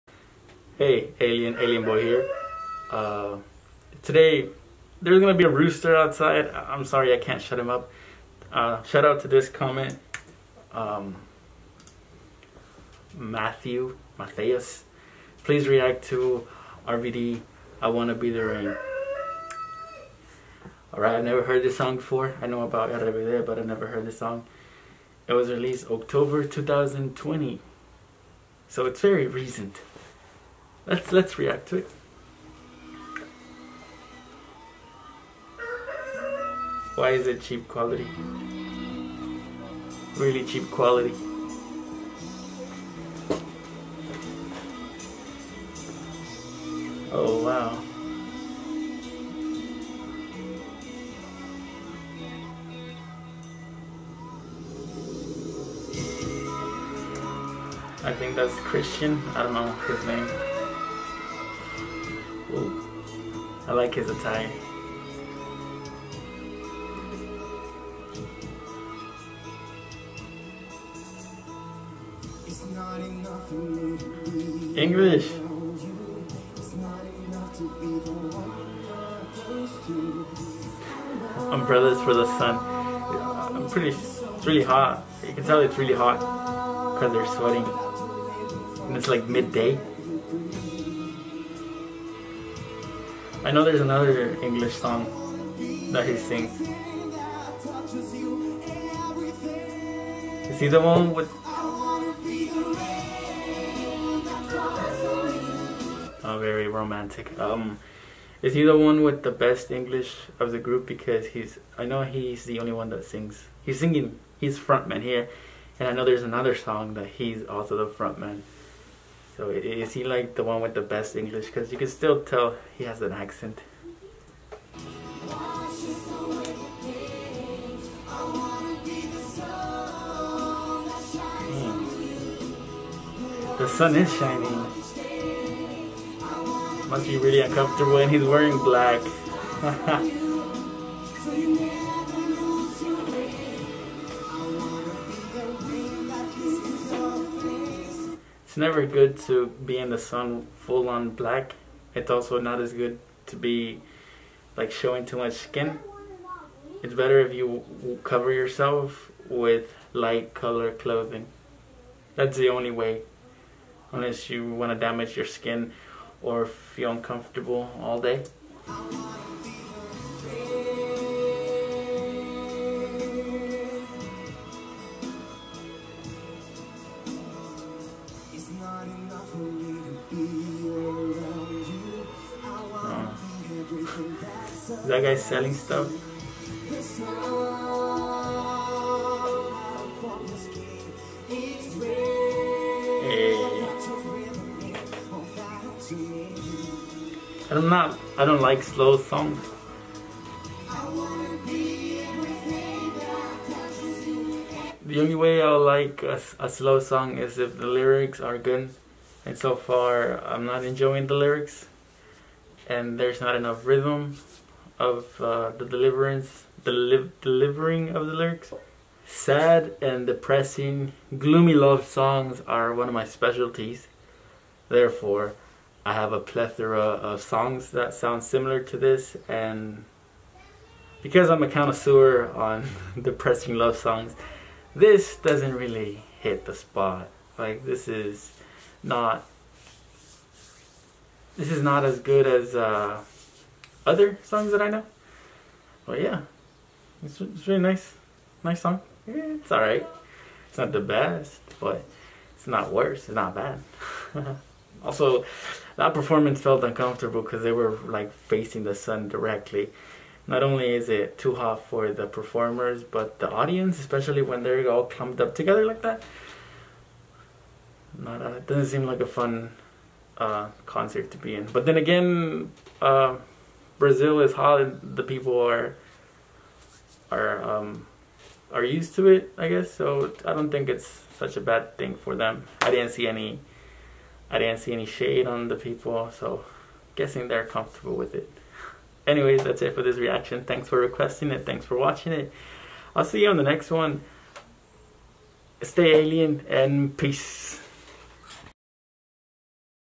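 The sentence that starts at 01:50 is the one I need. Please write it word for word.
Because he's, I know he's the only one that sings.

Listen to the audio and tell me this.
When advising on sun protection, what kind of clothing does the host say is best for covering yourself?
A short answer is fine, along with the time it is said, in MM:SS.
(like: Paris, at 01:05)
light color clothing, at 02:39.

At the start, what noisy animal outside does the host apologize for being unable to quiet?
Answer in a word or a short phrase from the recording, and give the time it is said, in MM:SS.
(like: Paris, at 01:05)
rooster, at 00:05.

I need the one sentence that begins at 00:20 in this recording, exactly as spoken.
Alright, I never heard this song before.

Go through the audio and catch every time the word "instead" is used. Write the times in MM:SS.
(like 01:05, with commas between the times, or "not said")
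not said.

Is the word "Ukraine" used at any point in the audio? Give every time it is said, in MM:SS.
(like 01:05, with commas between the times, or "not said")
not said.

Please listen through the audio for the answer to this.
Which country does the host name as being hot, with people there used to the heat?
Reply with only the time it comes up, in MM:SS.
04:33.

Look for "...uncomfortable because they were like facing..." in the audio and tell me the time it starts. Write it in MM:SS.
04:16.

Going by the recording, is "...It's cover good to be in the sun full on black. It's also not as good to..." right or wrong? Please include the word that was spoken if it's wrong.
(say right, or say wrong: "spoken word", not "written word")
wrong: "never", not "cover".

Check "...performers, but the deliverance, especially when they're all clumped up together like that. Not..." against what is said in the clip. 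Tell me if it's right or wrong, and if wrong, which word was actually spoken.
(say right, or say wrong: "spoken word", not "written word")
wrong: "audience", not "deliverance".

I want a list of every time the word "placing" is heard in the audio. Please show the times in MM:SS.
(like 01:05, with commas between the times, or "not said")
not said.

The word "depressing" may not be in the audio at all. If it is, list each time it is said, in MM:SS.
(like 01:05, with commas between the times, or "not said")
03:40, 03:53.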